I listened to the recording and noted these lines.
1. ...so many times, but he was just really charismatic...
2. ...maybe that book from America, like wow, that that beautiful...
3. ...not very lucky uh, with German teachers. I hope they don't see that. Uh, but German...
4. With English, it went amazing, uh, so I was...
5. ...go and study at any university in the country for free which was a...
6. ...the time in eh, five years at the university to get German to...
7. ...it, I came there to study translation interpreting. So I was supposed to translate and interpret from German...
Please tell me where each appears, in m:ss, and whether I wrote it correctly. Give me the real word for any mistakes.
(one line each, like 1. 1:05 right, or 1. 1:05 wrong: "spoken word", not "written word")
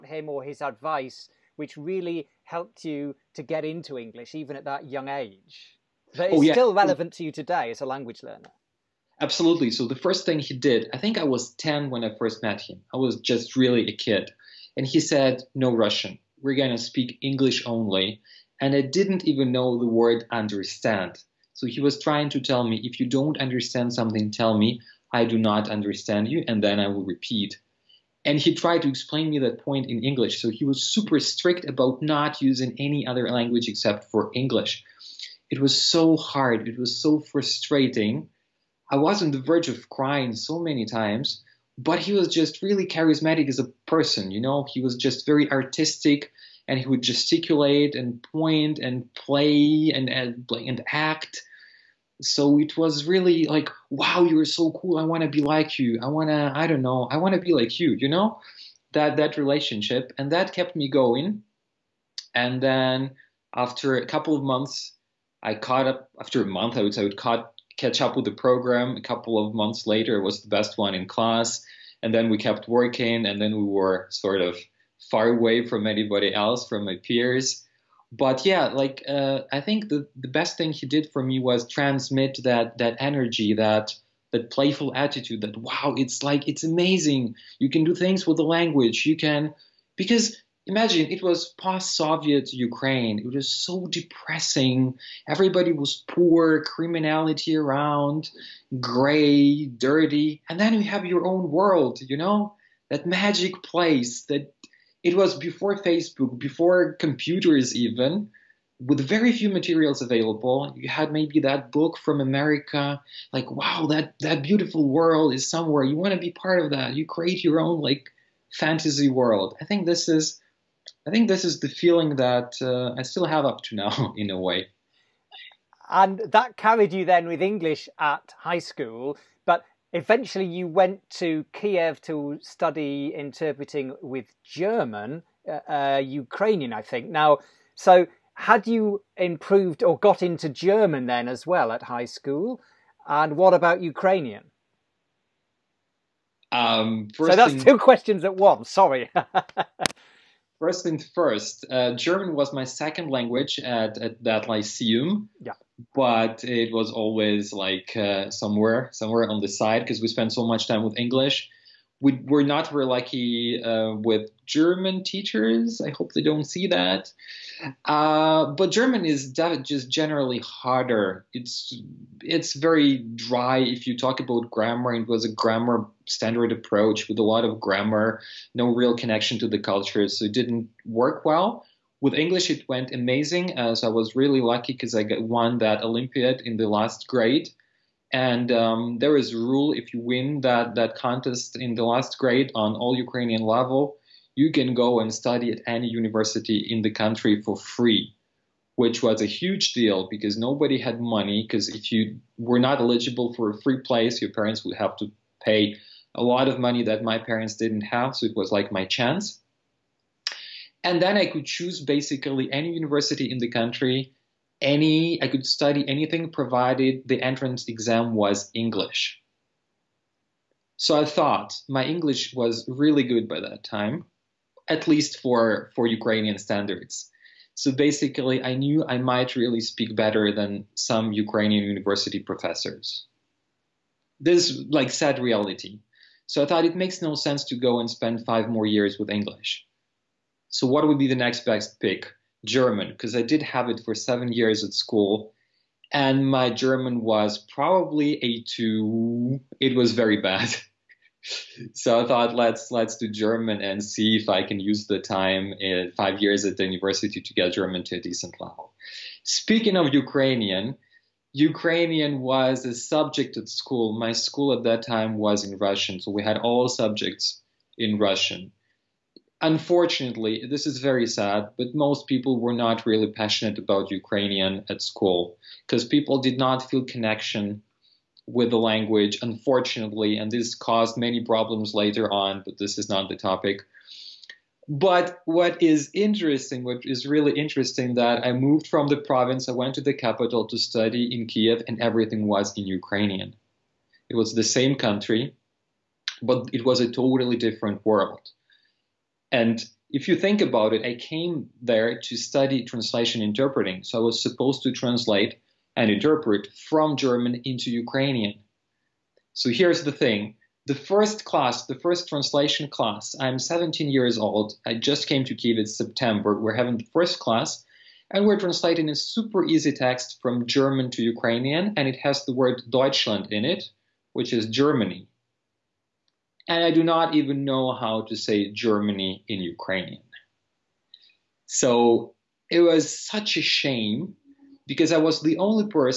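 1. 0:40 right
2. 1:51 right
3. 2:42 right
4. 3:02 right
5. 3:14 right
6. 4:14 right
7. 5:00 right.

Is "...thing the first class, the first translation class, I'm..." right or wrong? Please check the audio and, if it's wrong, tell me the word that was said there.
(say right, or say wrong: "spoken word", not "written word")
right.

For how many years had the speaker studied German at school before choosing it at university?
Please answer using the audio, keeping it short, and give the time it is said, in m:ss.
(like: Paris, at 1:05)
7, at 4:03.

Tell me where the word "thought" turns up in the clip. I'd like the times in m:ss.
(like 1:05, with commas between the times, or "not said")
3:41, 3:56, 4:12.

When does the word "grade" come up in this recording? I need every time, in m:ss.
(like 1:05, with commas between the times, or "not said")
3:07, 3:12.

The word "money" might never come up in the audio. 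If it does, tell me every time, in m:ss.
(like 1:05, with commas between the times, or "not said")
3:21, 3:26.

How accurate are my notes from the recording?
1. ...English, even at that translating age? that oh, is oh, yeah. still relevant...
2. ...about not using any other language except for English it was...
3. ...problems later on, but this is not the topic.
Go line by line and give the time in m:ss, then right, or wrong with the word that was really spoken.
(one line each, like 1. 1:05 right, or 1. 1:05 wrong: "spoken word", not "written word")
1. 0:03 wrong: "young", not "translating"
2. 0:31 right
3. 4:41 right.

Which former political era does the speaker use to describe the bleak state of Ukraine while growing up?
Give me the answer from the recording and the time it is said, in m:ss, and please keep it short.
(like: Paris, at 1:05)
post-Soviet, at 1:31.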